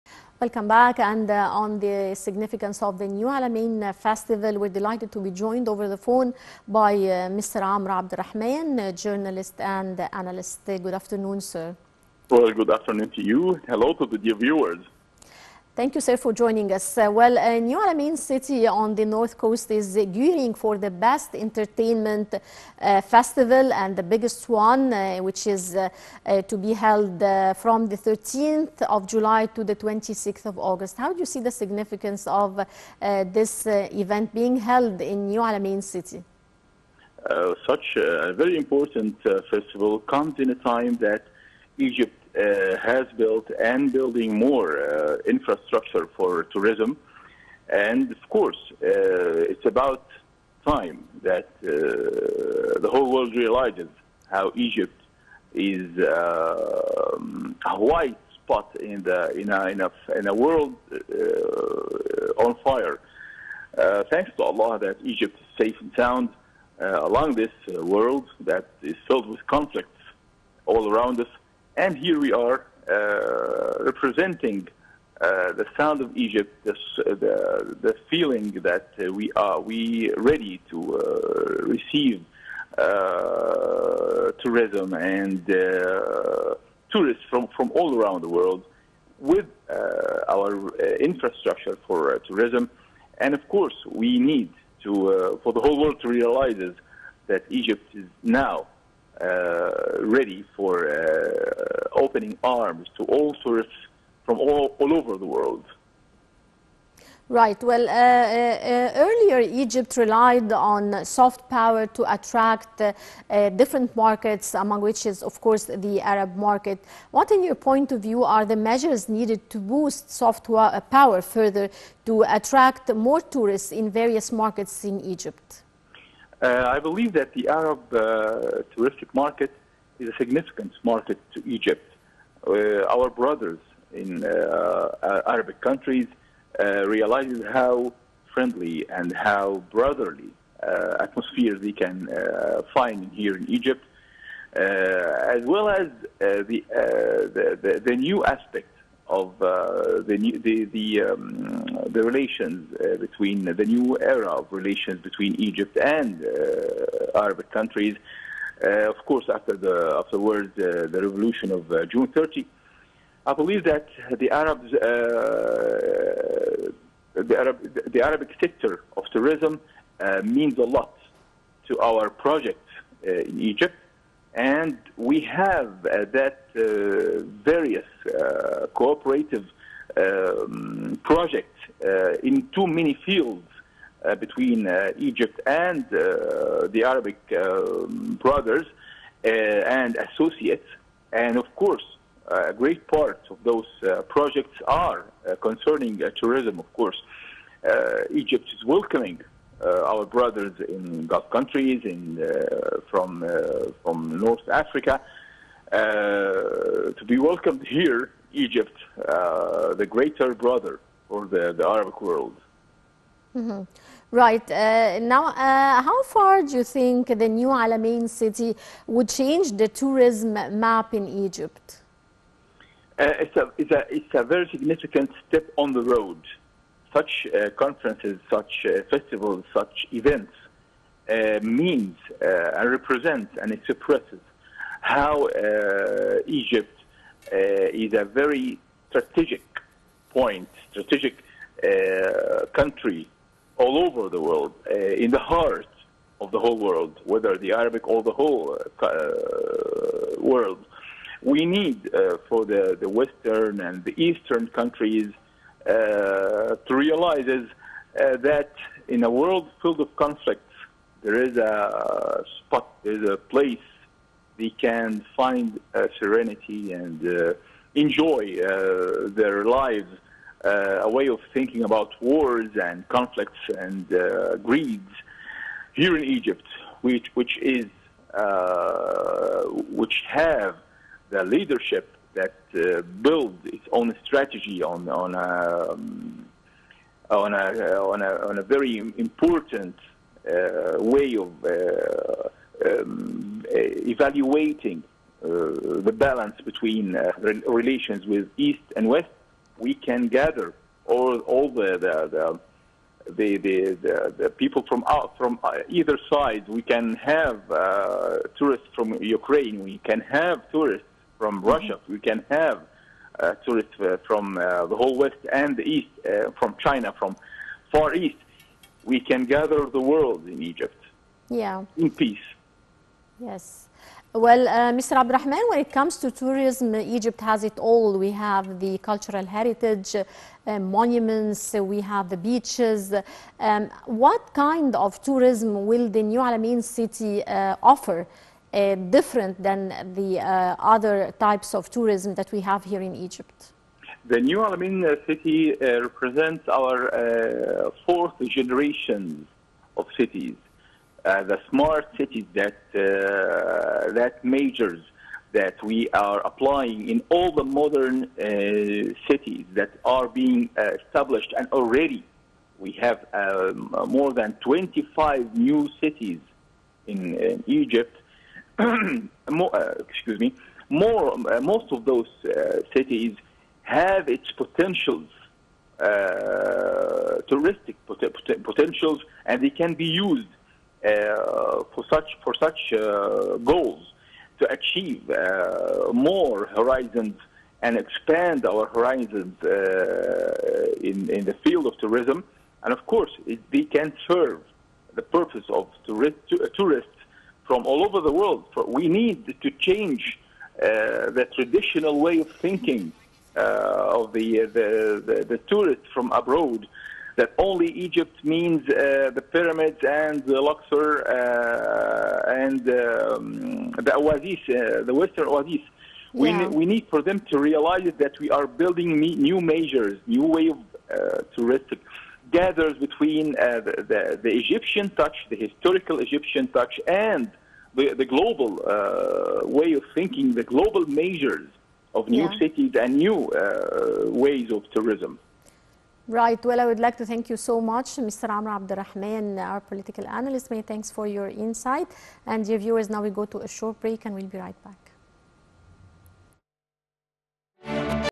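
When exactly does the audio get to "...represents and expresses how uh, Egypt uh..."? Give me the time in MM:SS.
03:52.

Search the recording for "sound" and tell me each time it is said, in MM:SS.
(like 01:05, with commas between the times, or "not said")
01:06, 01:15.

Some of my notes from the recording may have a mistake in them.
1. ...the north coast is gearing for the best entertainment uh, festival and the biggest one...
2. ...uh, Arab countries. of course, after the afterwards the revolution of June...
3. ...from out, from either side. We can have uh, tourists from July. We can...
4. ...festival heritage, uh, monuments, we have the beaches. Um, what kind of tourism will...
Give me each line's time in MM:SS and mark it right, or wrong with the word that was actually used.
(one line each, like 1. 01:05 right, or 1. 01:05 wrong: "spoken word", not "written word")
1. 00:18 right
2. 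02:36 right
3. 05:04 wrong: "Ukraine", not "July"
4. 05:28 wrong: "cultural", not "festival".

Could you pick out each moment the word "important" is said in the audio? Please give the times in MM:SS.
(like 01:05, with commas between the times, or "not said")
00:38, 04:48.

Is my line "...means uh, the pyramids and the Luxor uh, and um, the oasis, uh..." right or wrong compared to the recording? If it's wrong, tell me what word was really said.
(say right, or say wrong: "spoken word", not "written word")
right.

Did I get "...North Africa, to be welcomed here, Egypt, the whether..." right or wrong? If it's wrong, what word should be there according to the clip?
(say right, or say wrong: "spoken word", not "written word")
wrong: "greater", not "whether".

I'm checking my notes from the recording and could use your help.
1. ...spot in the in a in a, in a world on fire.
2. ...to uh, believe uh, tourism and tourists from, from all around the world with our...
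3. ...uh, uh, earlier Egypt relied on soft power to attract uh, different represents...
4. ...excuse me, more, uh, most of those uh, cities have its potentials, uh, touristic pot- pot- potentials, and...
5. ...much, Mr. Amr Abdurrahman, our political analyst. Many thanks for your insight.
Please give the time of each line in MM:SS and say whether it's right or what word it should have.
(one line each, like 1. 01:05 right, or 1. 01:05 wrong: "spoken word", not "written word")
1. 00:58 right
2. 01:20 wrong: "receive", not "believe"
3. 01:47 wrong: "markets", not "represents"
4. 06:09 right
5. 07:17 right.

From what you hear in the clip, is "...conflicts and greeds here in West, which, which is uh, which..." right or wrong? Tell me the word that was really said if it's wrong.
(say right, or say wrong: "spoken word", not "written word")
wrong: "Egypt", not "West".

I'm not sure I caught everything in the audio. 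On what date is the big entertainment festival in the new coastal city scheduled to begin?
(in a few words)
13th of July.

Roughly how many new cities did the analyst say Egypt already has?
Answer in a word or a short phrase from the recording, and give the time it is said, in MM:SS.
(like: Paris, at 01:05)
more than 25, at 06:03.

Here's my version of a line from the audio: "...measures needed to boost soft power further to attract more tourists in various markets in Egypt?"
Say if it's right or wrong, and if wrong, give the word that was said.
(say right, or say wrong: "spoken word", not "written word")
right.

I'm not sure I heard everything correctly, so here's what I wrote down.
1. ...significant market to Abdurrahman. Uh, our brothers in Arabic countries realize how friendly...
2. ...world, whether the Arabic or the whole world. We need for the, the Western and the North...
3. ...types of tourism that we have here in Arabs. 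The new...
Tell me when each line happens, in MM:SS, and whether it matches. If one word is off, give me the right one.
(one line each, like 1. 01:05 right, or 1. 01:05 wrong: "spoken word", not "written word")
1. 02:10 wrong: "Egypt", not "Abdurrahman"
2. 04:06 wrong: "Eastern", not "North"
3. 05:41 wrong: "Egypt", not "Arabs".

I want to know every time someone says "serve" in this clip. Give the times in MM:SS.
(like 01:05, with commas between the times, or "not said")
06:34.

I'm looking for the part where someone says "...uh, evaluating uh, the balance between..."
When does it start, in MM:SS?
04:53.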